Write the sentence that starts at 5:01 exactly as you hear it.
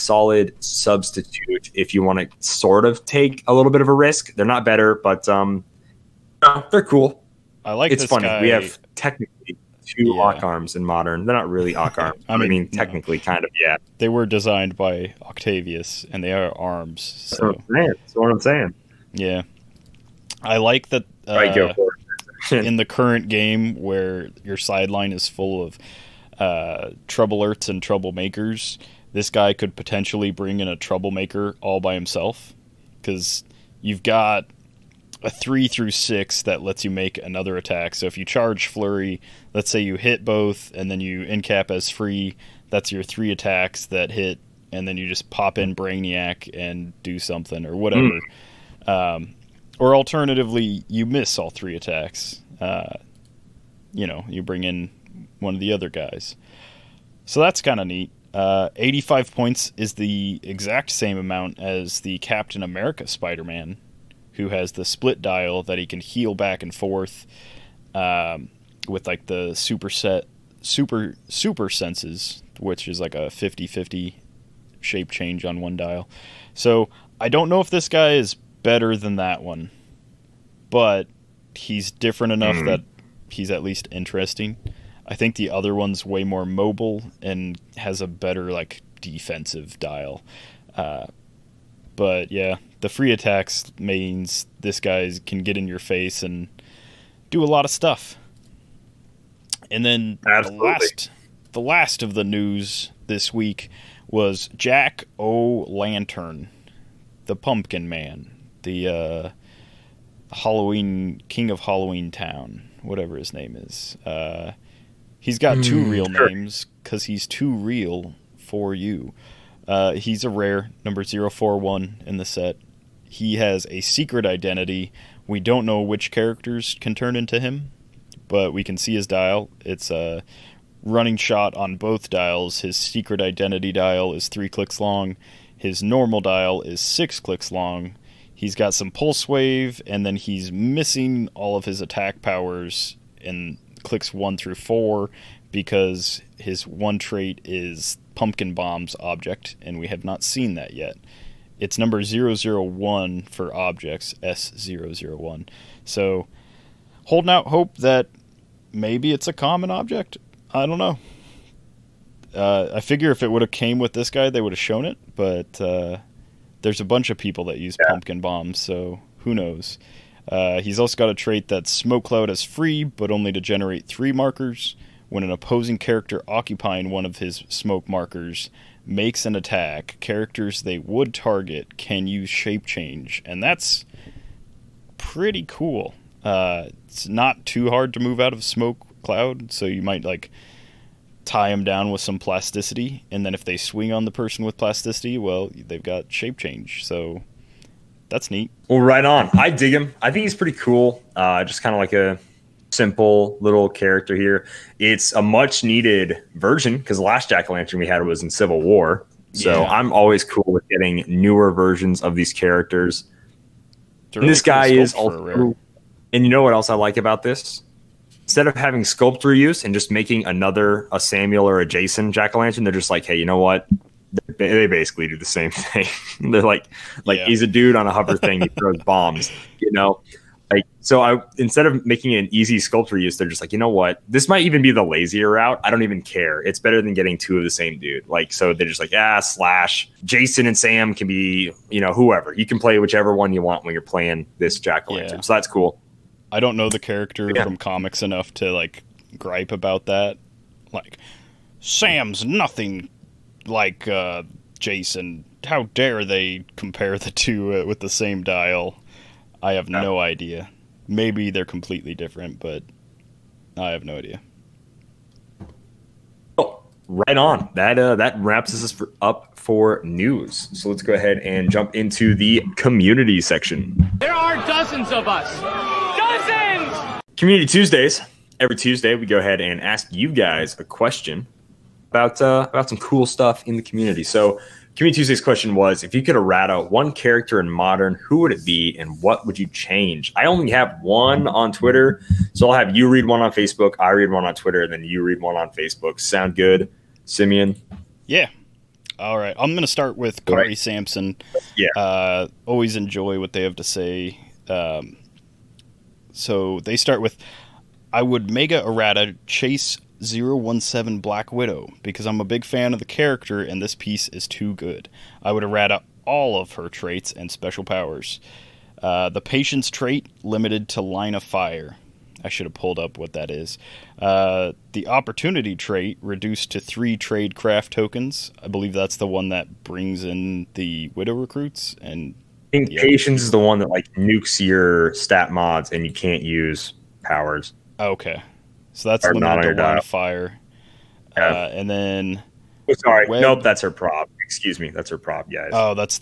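Yeah, uh, always enjoy what they have to say.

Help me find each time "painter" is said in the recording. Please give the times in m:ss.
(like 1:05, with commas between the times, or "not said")
not said.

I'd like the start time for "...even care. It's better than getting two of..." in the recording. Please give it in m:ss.
3:55.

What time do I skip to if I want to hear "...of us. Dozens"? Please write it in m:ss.
4:34.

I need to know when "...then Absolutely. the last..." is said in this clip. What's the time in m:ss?
1:39.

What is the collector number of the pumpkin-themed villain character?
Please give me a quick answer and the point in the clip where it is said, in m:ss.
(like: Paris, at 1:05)
041, at 2:01.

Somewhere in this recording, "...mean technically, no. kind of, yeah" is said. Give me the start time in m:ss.
0:12.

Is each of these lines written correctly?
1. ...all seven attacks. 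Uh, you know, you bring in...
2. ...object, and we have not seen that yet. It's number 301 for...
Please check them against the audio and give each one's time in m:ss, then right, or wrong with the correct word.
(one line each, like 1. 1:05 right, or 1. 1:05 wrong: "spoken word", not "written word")
1. 0:51 wrong: "three", not "seven"
2. 2:28 wrong: "001", not "301".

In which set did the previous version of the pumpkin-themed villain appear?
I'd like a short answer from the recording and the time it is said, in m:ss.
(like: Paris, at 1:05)
Civil War, at 3:28.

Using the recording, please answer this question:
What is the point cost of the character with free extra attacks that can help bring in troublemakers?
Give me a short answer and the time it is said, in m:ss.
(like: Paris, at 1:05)
85, at 0:58.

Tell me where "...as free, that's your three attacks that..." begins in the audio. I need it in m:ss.
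0:41.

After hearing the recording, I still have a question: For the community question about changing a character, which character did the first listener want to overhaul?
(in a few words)
Black Widow.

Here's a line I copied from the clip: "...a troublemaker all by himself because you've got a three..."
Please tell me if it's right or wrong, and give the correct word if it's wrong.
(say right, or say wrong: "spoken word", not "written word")
right.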